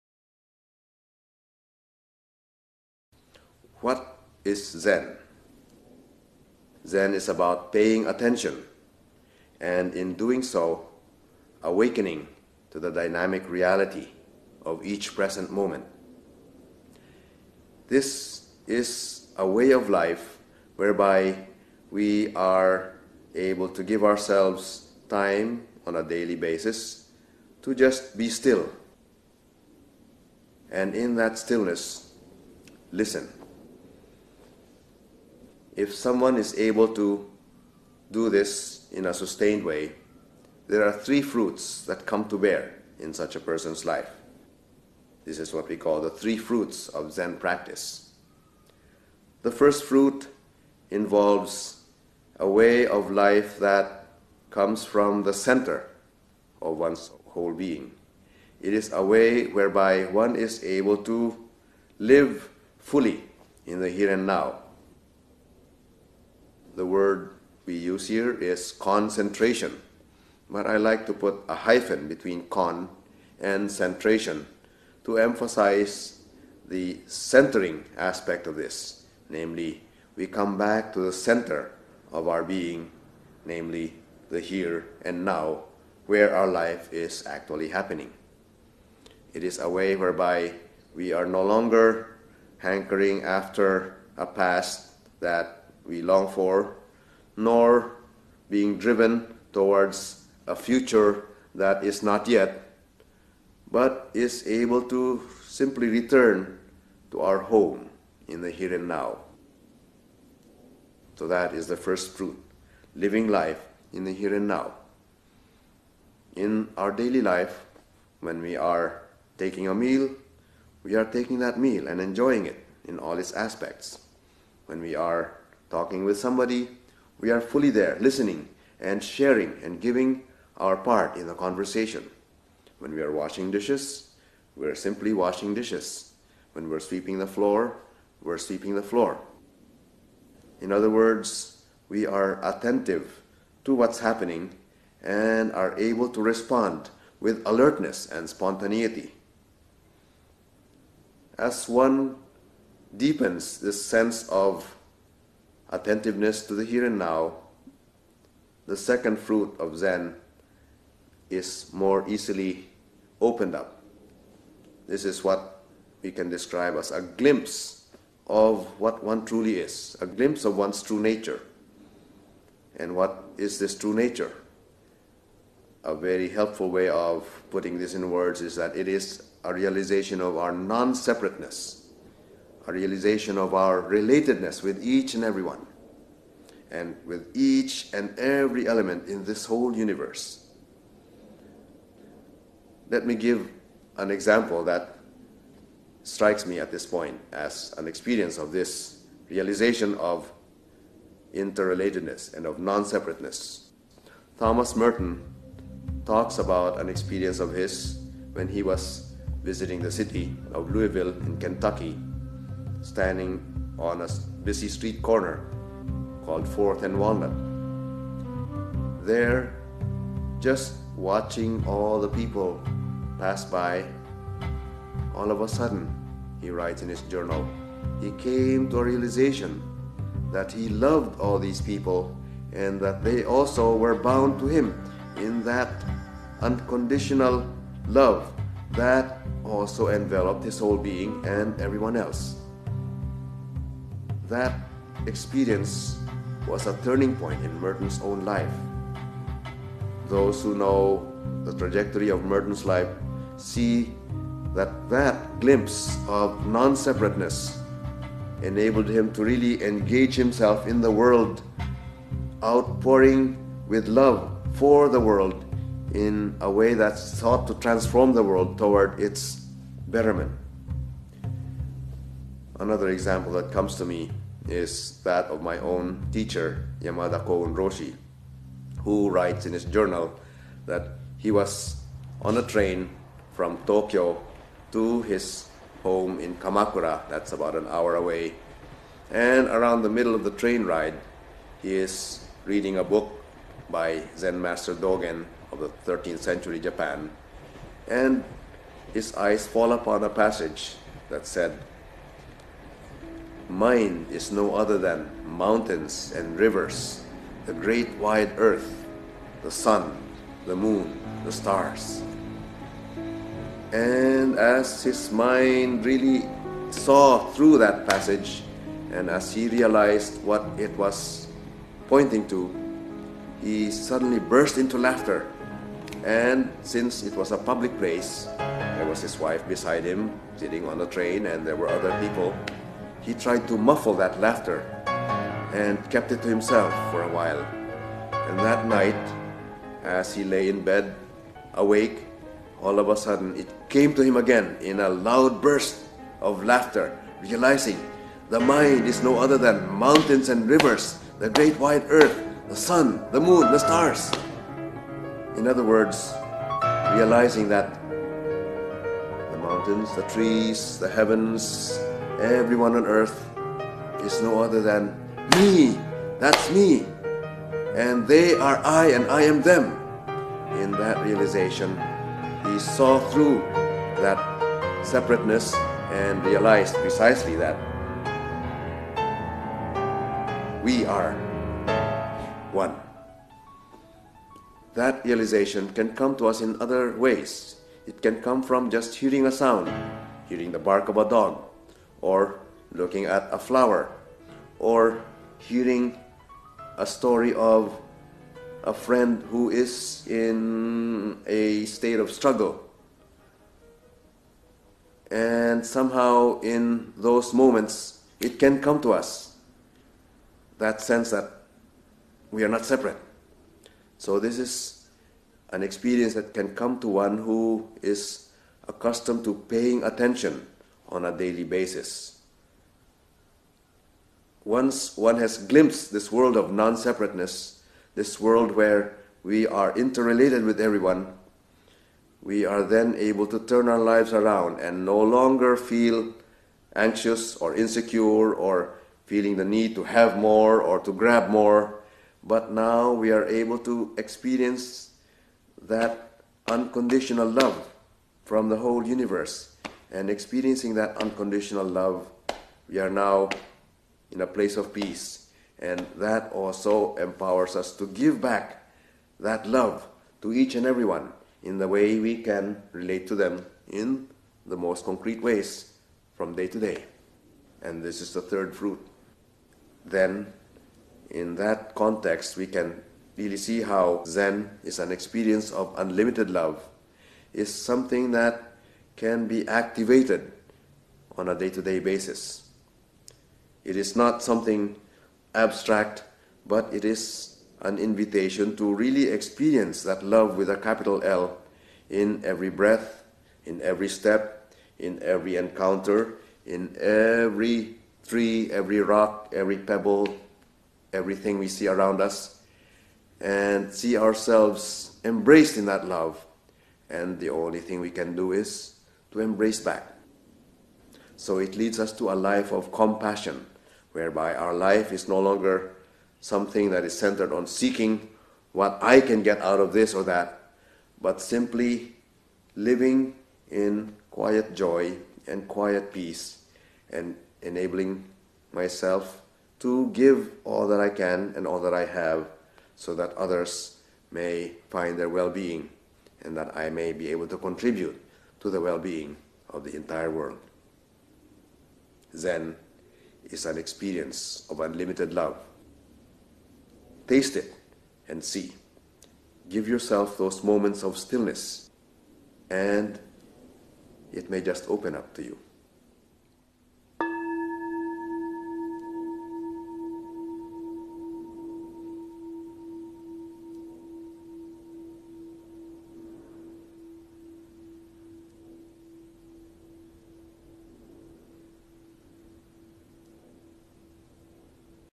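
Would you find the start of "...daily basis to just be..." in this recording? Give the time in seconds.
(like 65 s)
26 s.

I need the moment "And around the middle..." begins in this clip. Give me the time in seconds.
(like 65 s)
289 s.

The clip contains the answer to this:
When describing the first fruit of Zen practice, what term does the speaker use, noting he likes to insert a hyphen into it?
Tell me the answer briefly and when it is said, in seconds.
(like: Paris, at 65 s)
concentration, at 68 s.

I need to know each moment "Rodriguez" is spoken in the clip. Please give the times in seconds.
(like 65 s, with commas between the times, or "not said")
not said.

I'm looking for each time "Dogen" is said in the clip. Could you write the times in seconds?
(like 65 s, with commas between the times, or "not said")
294 s.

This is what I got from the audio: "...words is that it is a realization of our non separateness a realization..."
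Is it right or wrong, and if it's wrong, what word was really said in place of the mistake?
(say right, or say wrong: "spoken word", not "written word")
right.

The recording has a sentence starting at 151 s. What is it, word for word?
As one deepens this sense of attentiveness to the here and now.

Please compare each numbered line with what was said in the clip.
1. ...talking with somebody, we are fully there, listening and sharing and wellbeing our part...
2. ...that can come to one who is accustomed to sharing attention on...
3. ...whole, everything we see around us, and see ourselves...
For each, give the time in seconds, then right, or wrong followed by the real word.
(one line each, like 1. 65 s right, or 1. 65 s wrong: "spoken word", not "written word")
1. 125 s wrong: "giving", not "wellbeing"
2. 416 s wrong: "paying", not "sharing"
3. 499 s wrong: "pebble", not "whole".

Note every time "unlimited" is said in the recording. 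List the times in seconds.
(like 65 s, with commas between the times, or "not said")
475 s, 544 s.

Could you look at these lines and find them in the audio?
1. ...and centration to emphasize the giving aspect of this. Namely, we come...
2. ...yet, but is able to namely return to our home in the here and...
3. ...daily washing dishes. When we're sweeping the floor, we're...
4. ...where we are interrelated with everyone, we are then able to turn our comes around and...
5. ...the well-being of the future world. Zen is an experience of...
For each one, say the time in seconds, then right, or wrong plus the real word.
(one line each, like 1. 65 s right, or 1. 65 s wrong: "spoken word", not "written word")
1. 73 s wrong: "centering", not "giving"
2. 102 s wrong: "simply", not "namely"
3. 134 s wrong: "simply", not "daily"
4. 428 s wrong: "lives", not "comes"
5. 538 s wrong: "entire", not "future".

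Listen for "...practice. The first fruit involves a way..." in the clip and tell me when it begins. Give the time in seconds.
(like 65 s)
47 s.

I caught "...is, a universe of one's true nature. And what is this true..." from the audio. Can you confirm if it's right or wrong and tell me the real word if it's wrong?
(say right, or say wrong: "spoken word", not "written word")
wrong: "glimpse", not "universe".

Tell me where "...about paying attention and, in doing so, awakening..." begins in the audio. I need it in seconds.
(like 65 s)
7 s.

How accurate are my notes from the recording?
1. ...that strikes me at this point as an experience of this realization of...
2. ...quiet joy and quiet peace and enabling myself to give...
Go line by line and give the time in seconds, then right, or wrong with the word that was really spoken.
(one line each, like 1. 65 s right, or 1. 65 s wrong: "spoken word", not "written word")
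1. 194 s right
2. 524 s right.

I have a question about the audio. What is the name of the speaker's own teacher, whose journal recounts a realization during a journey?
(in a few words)
Yamada Koun Roshi.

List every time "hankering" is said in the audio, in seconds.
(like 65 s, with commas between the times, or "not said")
92 s.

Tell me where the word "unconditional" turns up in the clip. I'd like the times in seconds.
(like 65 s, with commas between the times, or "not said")
236 s, 446 s, 450 s.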